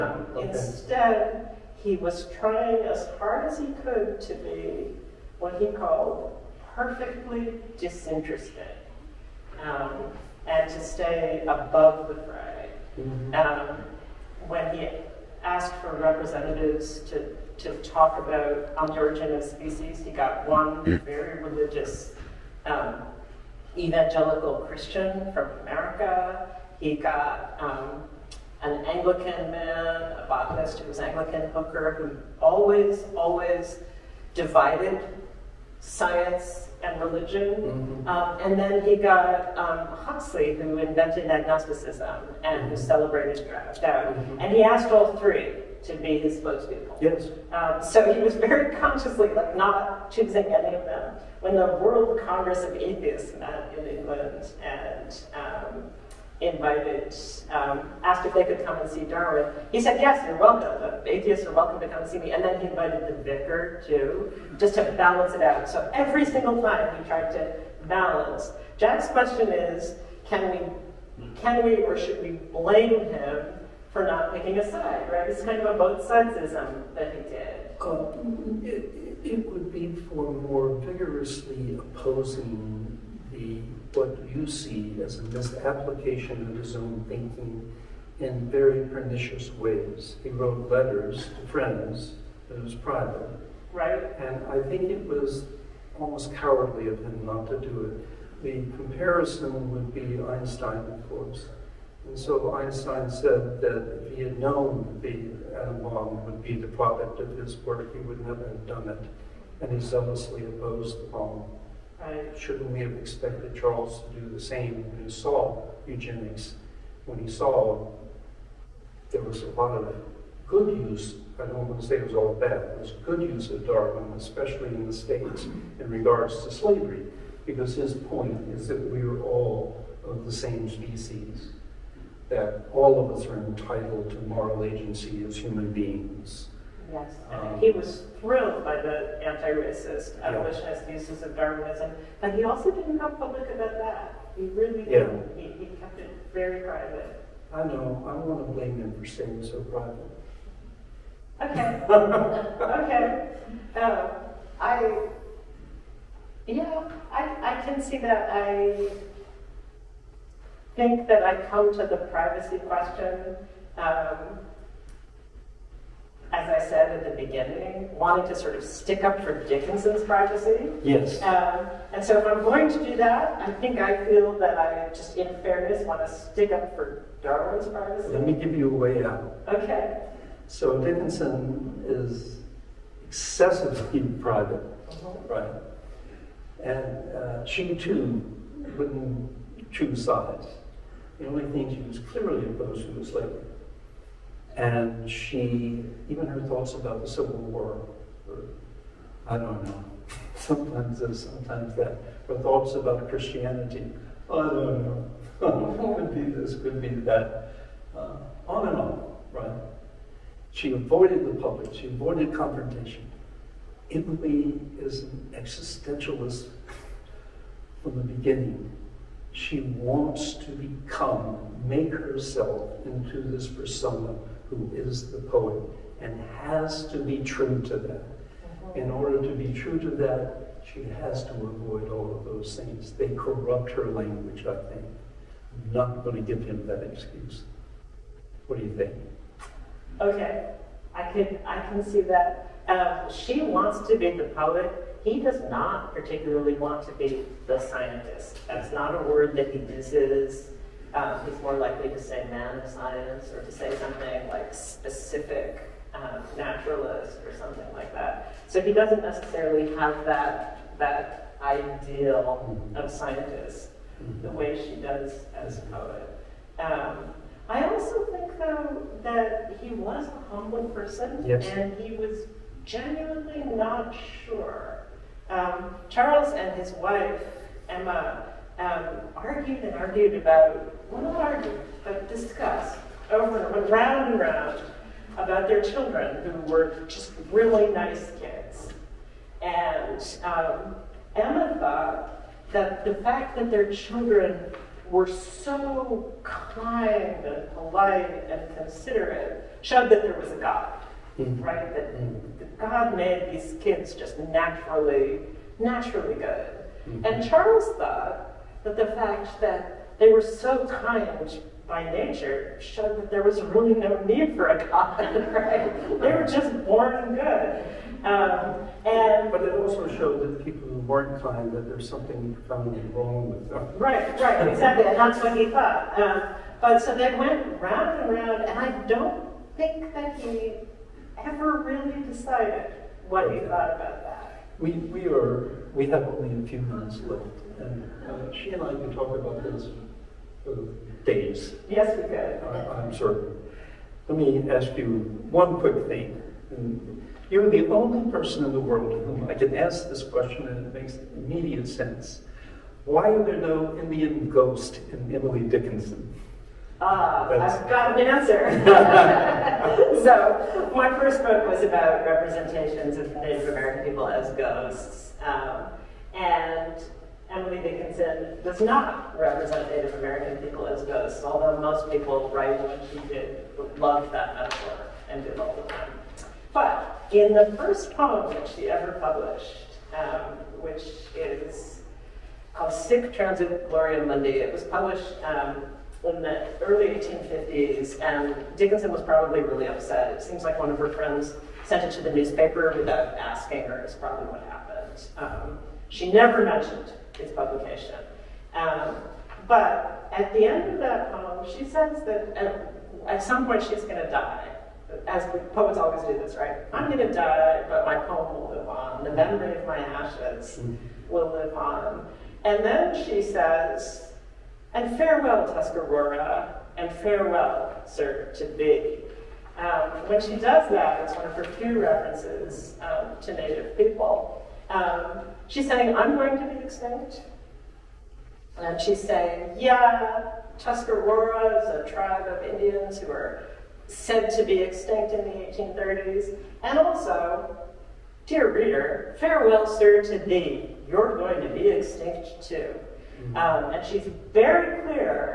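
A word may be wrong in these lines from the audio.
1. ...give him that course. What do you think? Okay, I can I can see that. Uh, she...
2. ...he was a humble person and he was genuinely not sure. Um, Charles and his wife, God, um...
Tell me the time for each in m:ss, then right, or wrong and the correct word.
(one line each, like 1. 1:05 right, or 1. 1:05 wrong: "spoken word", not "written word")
1. 3:56 wrong: "excuse", not "course"
2. 4:29 wrong: "Emma", not "God".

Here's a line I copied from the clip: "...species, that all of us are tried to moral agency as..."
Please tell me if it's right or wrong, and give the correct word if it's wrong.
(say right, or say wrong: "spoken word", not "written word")
wrong: "entitled", not "tried".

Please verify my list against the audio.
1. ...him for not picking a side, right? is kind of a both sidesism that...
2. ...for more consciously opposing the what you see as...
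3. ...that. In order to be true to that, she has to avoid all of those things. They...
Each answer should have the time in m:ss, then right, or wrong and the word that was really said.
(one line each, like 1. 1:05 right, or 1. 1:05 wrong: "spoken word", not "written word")
1. 1:12 right
2. 1:20 wrong: "vigorously", not "consciously"
3. 3:47 right.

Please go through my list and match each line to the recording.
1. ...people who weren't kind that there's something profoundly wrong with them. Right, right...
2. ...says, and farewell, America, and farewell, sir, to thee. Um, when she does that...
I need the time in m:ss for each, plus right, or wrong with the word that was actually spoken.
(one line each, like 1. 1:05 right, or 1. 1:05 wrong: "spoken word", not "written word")
1. 5:20 right
2. 6:53 wrong: "Tuscarora", not "America".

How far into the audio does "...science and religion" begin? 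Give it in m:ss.
0:35.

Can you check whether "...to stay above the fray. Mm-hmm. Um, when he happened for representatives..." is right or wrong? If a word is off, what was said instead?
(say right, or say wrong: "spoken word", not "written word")
wrong: "asked", not "happened".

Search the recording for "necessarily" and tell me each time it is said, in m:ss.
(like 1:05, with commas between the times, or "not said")
4:19.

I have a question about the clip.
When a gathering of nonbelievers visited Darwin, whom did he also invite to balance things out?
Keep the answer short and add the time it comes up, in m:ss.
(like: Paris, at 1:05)
The vicar, at 1:03.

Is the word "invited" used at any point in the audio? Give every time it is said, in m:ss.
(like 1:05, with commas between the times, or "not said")
0:56, 1:02.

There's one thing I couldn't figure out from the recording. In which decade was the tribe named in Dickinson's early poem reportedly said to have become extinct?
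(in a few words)
1830s.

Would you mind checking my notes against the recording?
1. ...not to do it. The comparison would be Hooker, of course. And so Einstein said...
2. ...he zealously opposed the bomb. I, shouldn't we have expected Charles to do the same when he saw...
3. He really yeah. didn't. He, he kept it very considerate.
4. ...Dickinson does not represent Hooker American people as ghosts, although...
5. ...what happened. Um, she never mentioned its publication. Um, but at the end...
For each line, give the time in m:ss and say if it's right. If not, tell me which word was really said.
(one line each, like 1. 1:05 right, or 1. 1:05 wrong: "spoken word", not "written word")
1. 1:37 wrong: "Einstein", not "Hooker"
2. 1:49 right
3. 2:24 wrong: "private", not "considerate"
4. 6:07 wrong: "Native", not "Hooker"
5. 6:34 right.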